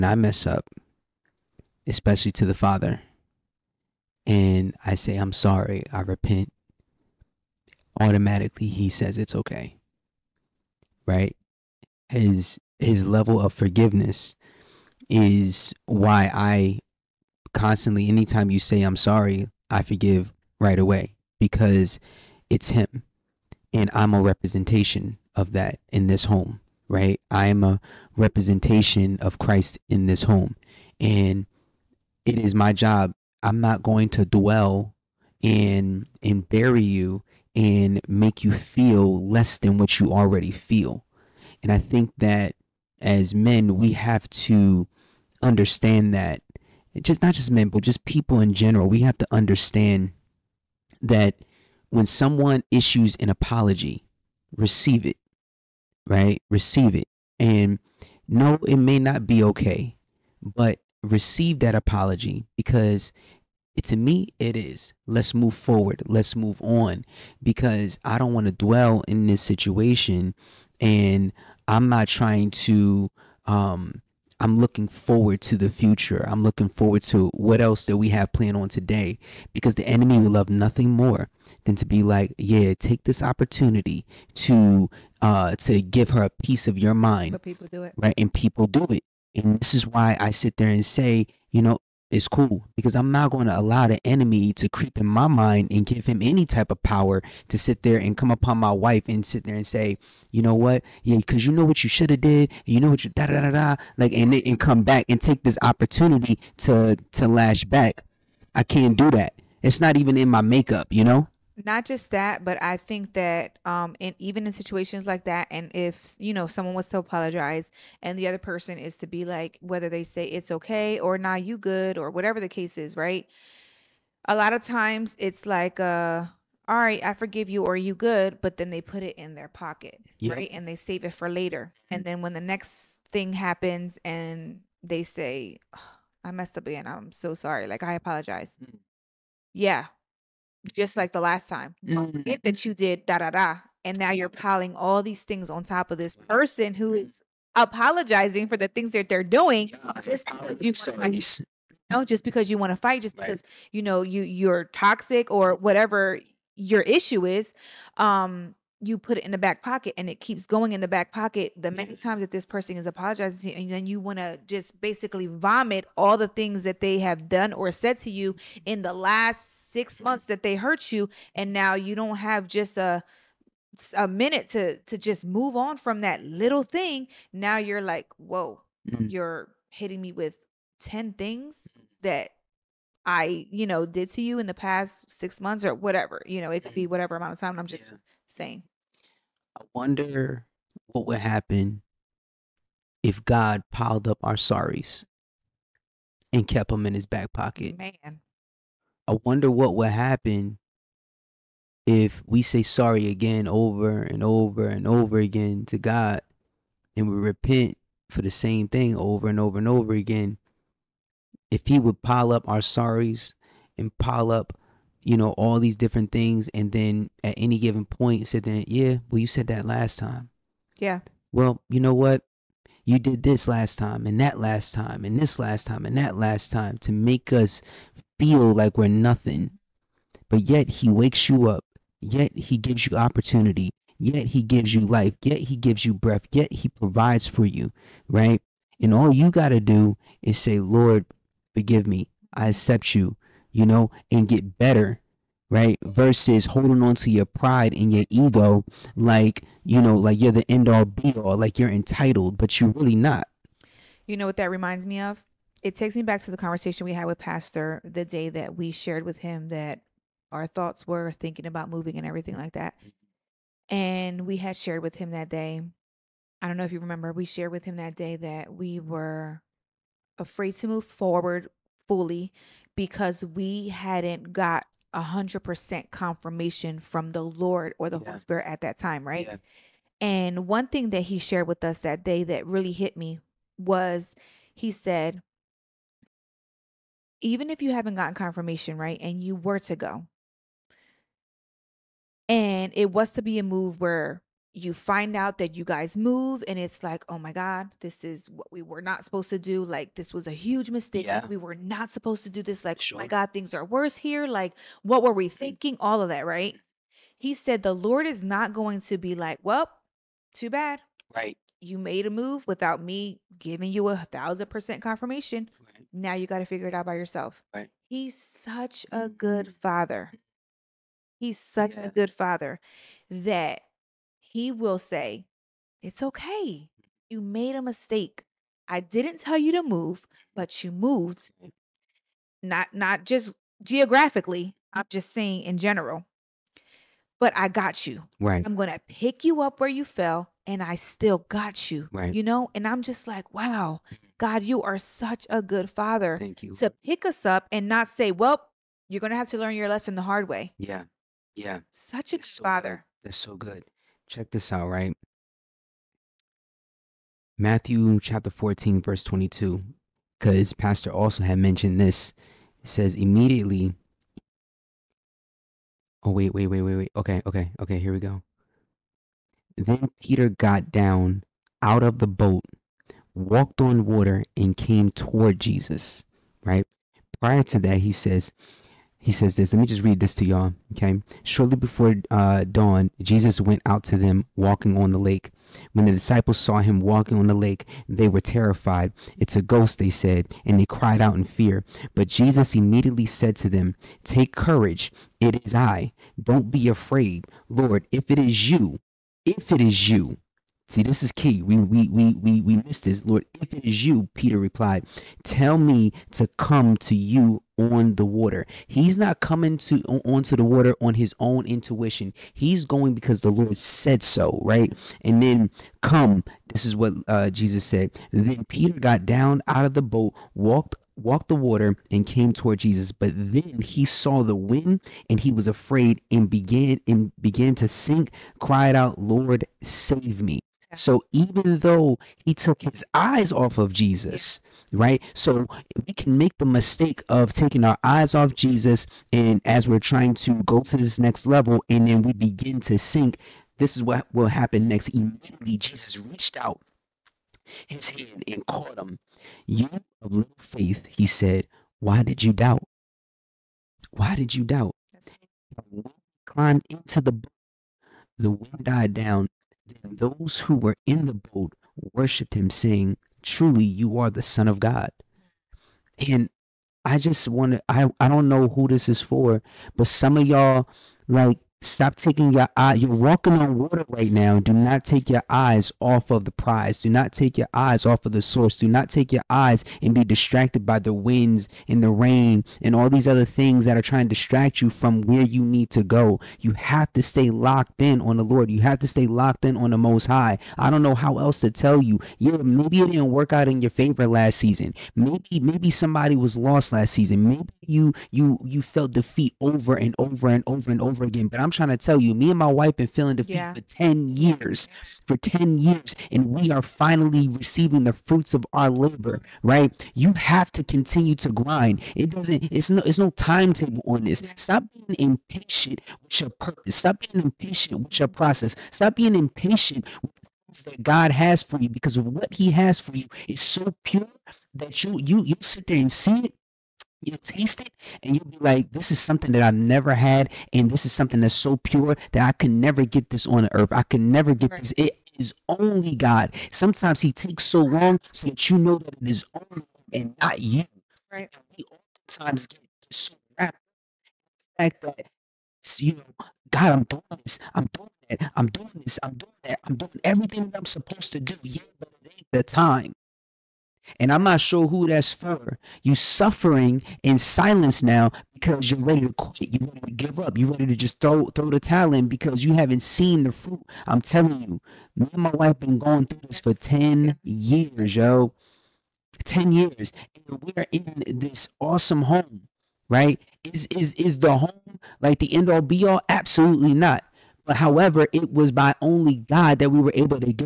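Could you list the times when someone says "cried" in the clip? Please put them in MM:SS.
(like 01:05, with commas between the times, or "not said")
06:30, 07:08.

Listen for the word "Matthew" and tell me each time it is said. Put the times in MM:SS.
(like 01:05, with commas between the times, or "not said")
05:57.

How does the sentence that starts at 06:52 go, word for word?
He's going because the Lord said so, right?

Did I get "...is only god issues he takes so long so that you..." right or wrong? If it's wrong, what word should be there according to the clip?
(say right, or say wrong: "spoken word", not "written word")
wrong: "sometimes", not "issues".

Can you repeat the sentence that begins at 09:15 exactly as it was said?
You suffering in silence now because you're ready to quit.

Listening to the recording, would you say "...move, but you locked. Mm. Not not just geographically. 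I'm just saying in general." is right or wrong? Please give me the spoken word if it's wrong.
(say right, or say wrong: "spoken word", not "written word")
wrong: "moved", not "locked".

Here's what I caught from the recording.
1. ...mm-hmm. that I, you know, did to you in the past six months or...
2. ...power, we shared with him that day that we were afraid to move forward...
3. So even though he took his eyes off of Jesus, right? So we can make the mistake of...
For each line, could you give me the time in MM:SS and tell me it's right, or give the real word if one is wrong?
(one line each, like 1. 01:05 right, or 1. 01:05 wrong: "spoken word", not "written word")
1. 03:01 right
2. 04:26 wrong: "remember", not "power"
3. 07:10 right.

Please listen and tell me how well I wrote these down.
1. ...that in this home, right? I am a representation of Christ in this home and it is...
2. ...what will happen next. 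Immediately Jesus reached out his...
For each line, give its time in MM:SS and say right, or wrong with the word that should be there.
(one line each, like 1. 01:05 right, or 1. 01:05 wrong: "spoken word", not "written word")
1. 00:25 right
2. 07:23 right.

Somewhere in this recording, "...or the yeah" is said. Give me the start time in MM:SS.
04:37.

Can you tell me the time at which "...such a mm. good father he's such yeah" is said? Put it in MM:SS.
05:18.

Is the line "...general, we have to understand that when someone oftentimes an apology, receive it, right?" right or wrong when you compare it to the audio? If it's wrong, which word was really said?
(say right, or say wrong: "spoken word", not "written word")
wrong: "issues", not "oftentimes".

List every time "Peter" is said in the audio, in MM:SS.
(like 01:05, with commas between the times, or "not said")
06:10, 06:44, 06:58.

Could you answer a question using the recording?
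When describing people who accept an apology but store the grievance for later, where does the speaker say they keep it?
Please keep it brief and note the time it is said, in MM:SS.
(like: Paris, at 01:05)
In their pocket, at 02:08.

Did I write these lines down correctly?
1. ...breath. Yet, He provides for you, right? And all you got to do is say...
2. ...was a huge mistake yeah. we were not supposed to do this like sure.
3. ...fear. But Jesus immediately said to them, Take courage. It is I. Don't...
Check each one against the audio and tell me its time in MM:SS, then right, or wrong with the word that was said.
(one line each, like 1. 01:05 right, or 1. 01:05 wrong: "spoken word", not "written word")
1. 03:55 right
2. 05:00 right
3. 06:31 right.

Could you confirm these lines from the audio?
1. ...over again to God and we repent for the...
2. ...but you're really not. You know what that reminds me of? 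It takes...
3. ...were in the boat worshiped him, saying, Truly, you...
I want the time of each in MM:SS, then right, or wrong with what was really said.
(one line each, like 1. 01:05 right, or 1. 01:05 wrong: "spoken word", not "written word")
1. 03:24 right
2. 04:12 right
3. 07:40 right.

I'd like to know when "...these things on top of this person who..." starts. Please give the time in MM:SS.
02:25.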